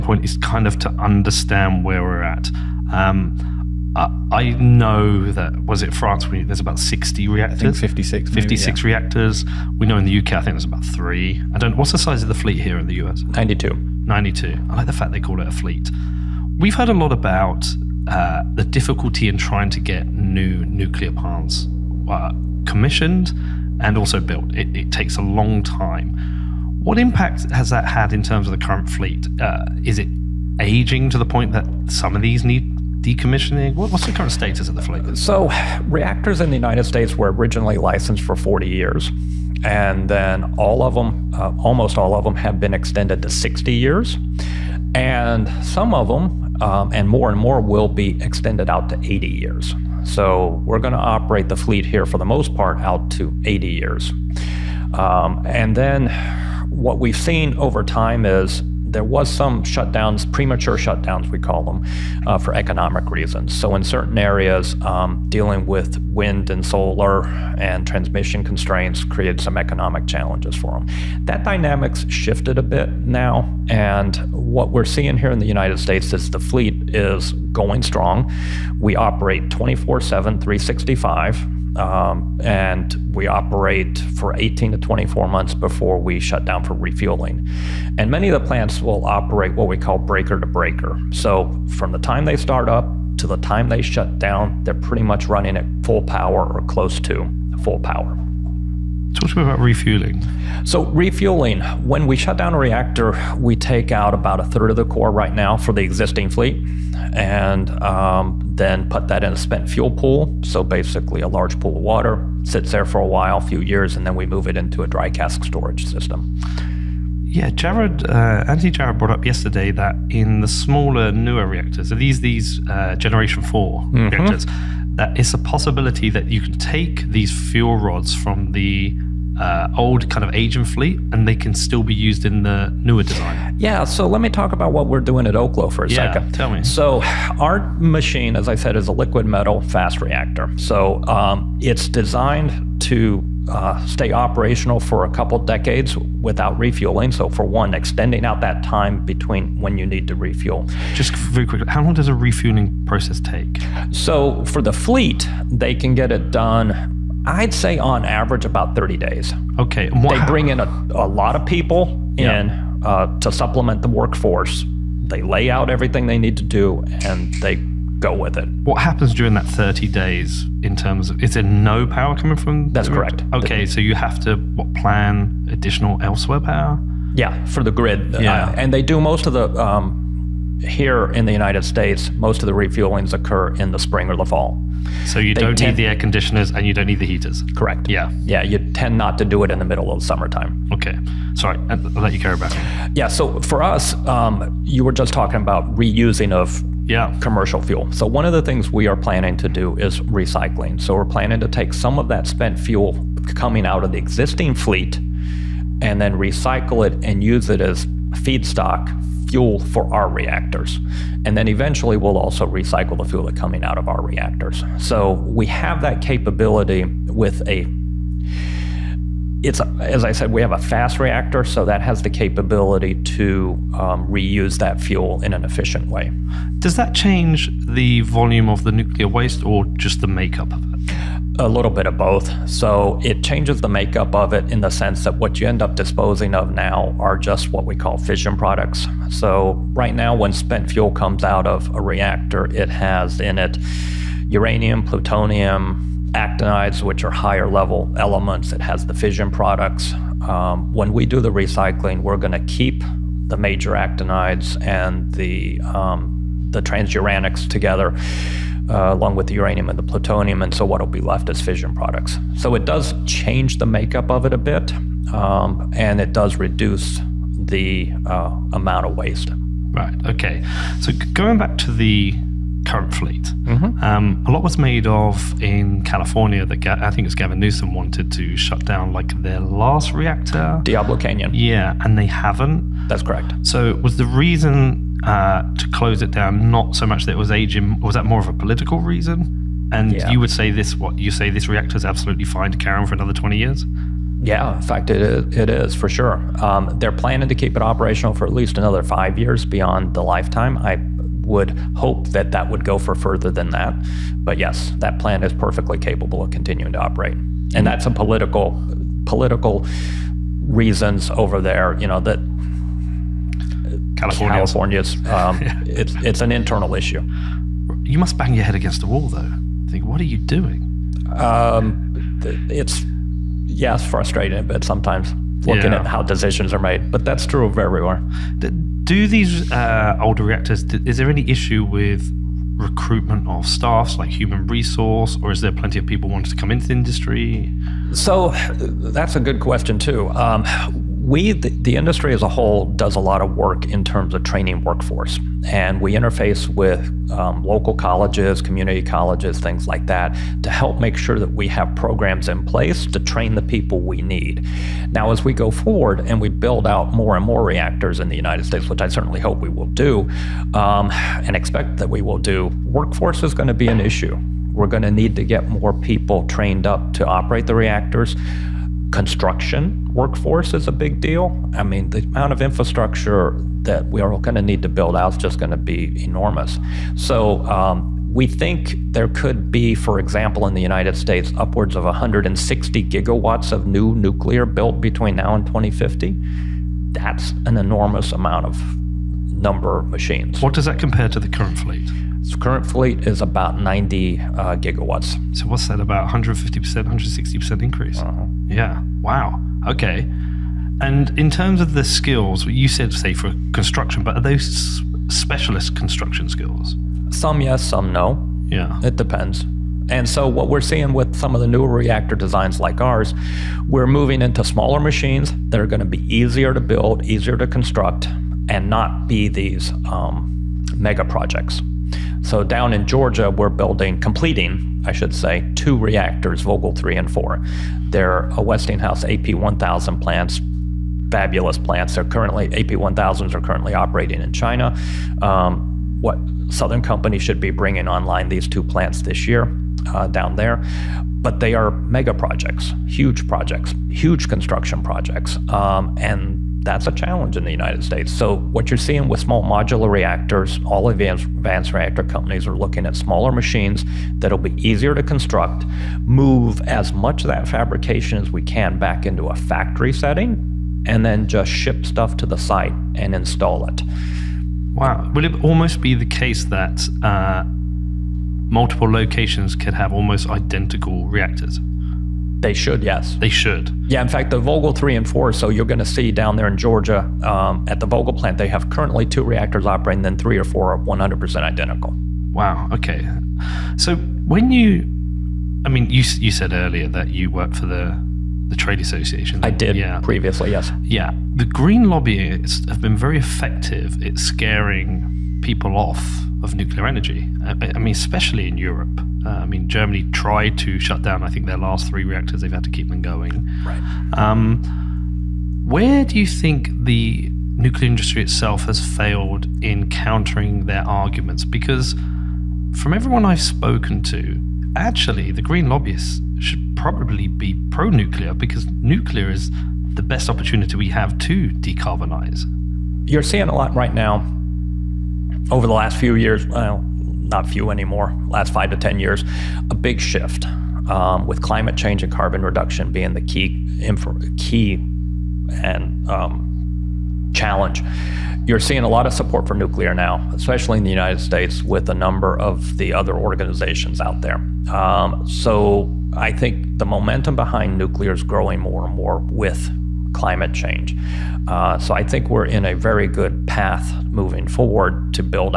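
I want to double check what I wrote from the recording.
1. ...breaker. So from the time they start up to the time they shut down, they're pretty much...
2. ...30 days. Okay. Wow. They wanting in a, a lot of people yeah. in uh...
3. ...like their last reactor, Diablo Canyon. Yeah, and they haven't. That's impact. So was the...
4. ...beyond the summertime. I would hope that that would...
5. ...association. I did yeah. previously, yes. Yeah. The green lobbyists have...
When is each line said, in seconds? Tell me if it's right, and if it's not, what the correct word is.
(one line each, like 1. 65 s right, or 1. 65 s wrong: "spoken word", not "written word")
1. 90 s right
2. 158 s wrong: "bring", not "wanting"
3. 278 s wrong: "correct", not "impact"
4. 299 s wrong: "lifetime", not "summertime"
5. 488 s right.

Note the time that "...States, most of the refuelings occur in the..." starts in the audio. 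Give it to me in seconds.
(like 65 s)
181 s.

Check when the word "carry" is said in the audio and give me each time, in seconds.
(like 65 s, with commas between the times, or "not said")
192 s, 292 s.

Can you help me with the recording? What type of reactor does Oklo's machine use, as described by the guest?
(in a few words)
liquid metal fast reactor.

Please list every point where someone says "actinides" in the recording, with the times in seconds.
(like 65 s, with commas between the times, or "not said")
246 s, 253 s.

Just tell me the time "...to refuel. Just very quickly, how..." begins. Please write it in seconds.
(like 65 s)
150 s.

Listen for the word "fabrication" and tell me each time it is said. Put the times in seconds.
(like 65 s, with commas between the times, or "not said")
457 s.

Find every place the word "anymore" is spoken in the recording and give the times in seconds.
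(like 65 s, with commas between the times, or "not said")
527 s.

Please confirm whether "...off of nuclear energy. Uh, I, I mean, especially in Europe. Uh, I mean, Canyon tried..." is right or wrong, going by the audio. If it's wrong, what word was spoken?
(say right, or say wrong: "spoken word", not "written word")
wrong: "Germany", not "Canyon".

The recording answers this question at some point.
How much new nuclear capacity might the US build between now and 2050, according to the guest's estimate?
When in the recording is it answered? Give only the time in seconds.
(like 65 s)
381 s.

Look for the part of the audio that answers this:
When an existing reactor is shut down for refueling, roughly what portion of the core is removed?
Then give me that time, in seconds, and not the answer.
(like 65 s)
104 s.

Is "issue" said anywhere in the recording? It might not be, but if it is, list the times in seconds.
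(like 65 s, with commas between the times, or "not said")
316 s, 331 s, 363 s.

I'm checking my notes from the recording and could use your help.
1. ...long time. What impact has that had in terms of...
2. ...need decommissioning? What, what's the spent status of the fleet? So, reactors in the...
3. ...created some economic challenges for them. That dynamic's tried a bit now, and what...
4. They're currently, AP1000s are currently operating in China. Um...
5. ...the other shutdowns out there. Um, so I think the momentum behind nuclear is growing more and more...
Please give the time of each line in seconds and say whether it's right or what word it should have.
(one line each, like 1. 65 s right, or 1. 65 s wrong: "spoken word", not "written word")
1. 25 s right
2. 32 s wrong: "current", not "spent"
3. 69 s wrong: "shifted", not "tried"
4. 431 s right
5. 542 s wrong: "organizations", not "shutdowns".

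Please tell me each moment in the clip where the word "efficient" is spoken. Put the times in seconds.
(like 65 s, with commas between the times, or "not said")
225 s.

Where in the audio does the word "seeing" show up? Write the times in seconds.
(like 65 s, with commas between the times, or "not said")
74 s, 410 s, 448 s, 523 s, 538 s.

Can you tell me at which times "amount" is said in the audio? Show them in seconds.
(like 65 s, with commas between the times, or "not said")
268 s, 372 s, 388 s.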